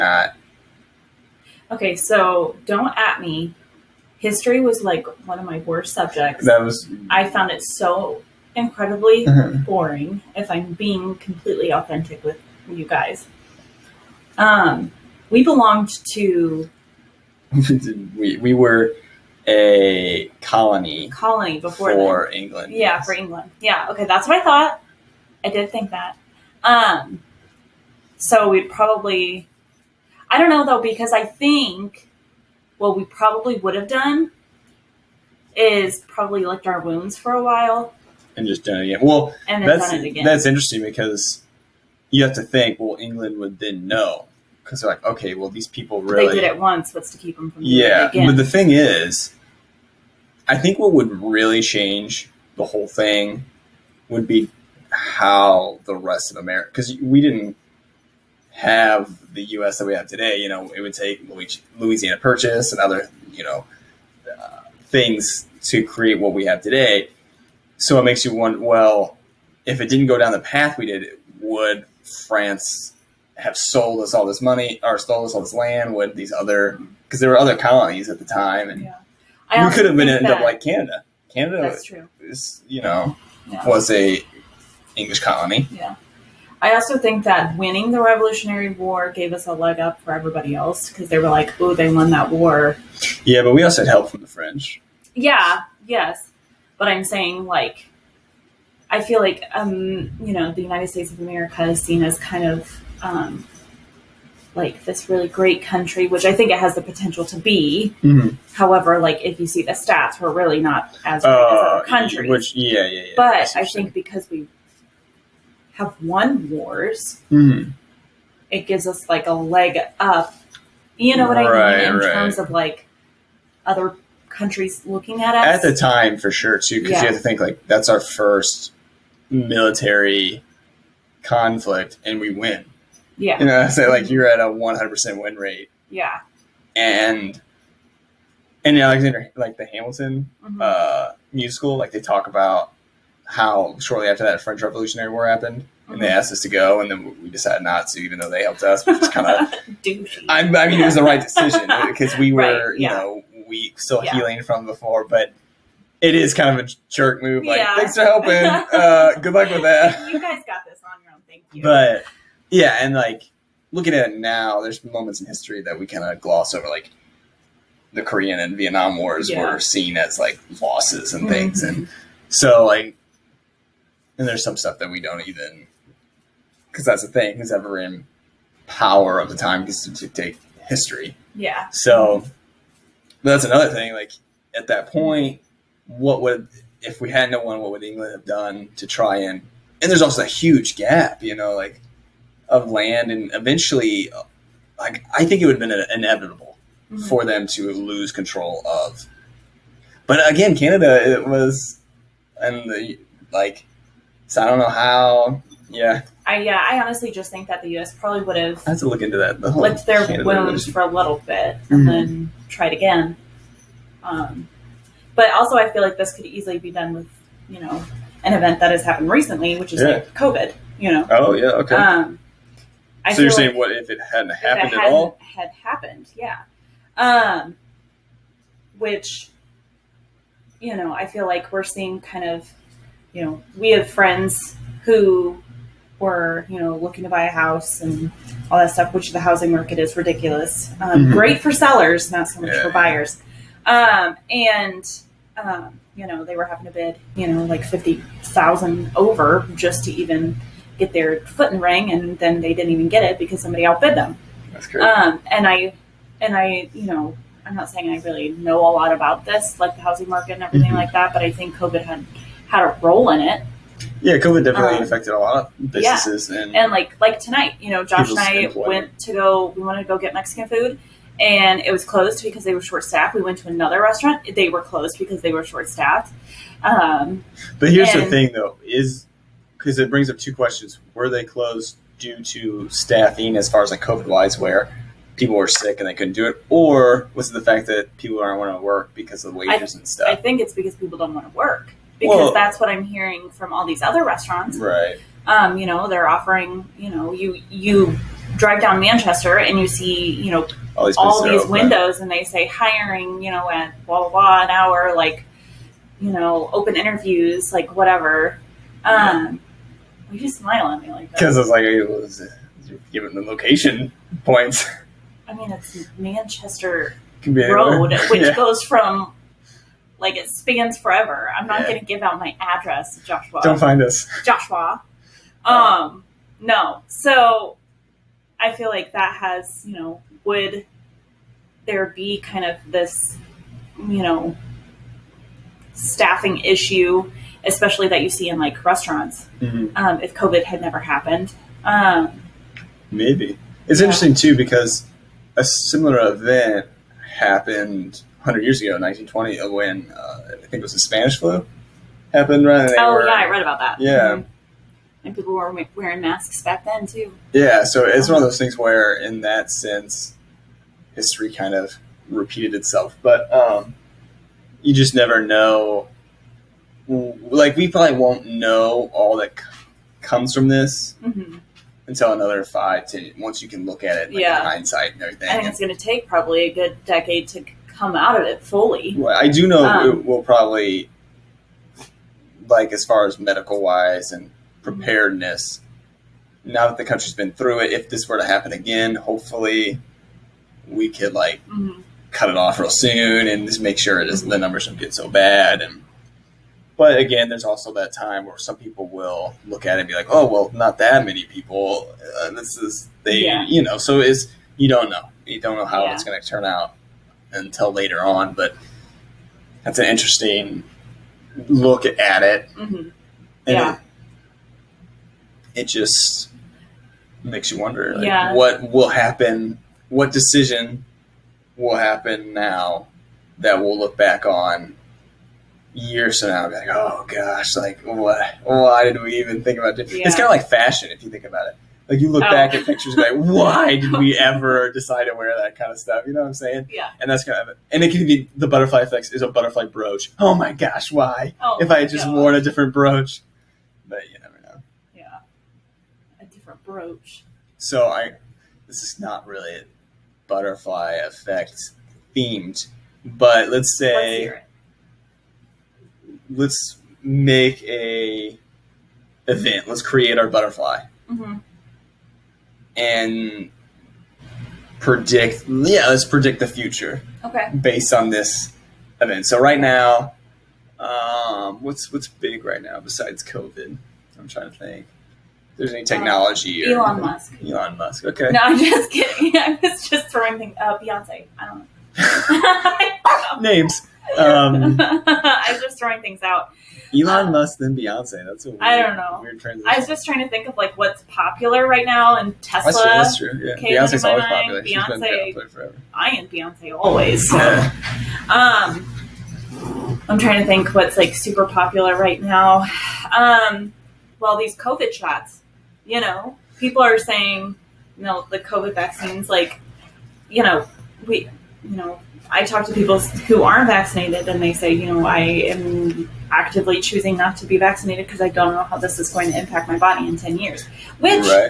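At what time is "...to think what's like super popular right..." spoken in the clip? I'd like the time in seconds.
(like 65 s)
500 s.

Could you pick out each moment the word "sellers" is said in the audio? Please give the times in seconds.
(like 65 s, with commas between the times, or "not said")
241 s.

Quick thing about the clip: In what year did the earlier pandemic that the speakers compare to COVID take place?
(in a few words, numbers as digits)
1920.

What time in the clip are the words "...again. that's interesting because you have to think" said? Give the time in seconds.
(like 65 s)
39 s.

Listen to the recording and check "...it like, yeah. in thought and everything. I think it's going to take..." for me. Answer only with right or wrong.
wrong.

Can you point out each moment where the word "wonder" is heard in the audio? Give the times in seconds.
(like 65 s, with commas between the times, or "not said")
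68 s, 417 s.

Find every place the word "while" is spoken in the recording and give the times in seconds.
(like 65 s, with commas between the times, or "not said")
37 s.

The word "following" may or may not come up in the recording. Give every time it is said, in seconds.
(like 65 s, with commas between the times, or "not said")
not said.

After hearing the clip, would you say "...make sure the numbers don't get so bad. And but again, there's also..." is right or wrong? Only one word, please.
right.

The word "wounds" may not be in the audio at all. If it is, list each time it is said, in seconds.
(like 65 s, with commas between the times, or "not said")
36 s, 210 s.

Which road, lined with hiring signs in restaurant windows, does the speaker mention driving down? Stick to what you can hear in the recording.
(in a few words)
Manchester Road.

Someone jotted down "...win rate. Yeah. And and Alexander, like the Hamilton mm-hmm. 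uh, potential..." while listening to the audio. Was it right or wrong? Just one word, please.
wrong.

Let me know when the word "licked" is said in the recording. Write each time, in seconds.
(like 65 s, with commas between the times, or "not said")
36 s, 209 s.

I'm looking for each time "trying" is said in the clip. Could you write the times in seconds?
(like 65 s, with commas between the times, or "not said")
474 s, 490 s, 500 s.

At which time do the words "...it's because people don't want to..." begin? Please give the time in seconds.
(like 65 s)
290 s.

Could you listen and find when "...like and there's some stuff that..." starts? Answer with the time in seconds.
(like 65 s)
172 s.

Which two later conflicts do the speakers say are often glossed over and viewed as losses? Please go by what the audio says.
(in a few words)
Korean and Vietnam wars.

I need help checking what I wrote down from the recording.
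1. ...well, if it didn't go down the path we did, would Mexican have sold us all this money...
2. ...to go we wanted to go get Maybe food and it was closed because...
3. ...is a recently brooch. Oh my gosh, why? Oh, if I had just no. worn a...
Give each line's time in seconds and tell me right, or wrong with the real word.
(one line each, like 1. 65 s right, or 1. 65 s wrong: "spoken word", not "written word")
1. 68 s wrong: "France", not "Mexican"
2. 269 s wrong: "Mexican", not "Maybe"
3. 439 s wrong: "butterfly", not "recently".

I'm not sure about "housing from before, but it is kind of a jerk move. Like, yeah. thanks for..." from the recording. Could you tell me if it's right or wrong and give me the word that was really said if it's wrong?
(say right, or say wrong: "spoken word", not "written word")
wrong: "healing", not "housing".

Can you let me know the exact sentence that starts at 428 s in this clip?
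Why did we even think about it?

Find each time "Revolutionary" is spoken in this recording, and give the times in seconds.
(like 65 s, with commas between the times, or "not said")
88 s, 144 s.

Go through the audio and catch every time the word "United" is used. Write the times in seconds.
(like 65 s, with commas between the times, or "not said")
100 s.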